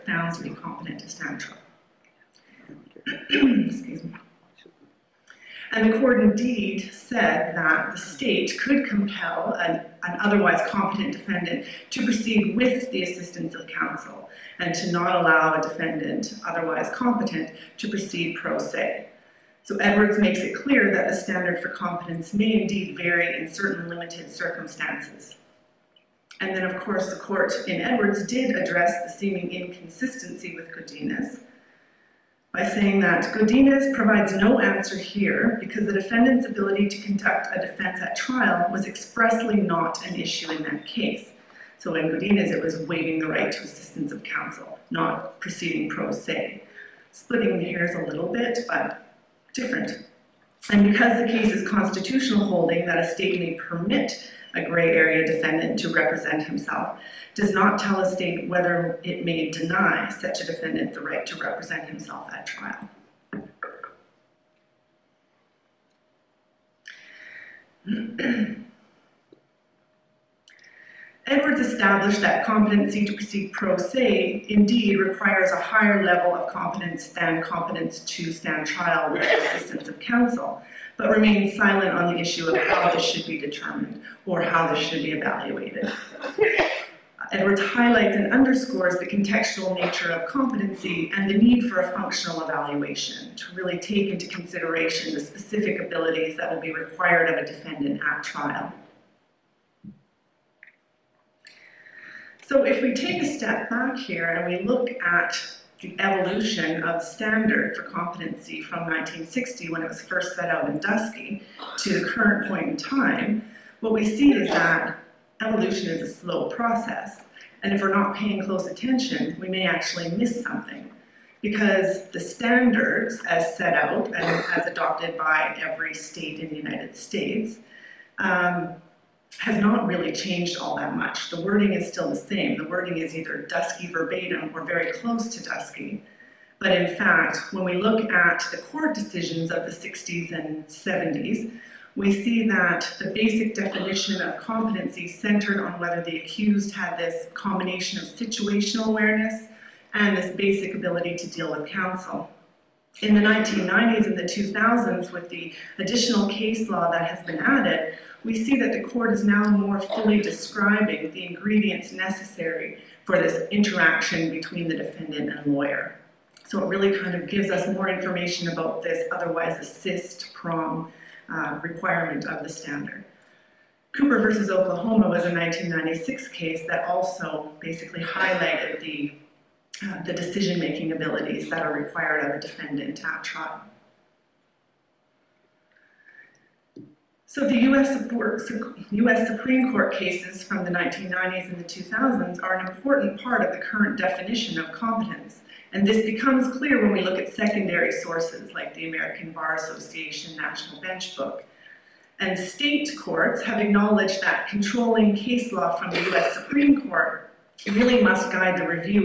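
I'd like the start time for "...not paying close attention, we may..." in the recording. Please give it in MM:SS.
01:57.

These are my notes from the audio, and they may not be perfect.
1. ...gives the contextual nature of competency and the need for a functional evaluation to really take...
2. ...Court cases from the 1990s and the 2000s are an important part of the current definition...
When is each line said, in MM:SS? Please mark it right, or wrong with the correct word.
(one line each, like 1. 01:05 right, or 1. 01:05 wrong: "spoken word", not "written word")
1. 01:28 wrong: "underscores", not "gives"
2. 03:09 right.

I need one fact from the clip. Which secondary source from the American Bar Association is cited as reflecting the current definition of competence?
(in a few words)
National Bench Book.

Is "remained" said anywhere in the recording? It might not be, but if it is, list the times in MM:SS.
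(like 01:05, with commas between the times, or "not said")
01:21.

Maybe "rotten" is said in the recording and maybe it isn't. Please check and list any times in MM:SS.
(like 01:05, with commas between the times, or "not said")
not said.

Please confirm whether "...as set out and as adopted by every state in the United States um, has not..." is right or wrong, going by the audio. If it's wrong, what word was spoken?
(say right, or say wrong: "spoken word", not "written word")
right.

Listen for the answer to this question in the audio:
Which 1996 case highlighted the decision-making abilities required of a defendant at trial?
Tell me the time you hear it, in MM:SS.
02:53.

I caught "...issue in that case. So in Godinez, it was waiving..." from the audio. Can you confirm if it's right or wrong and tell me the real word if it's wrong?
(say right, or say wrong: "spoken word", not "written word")
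right.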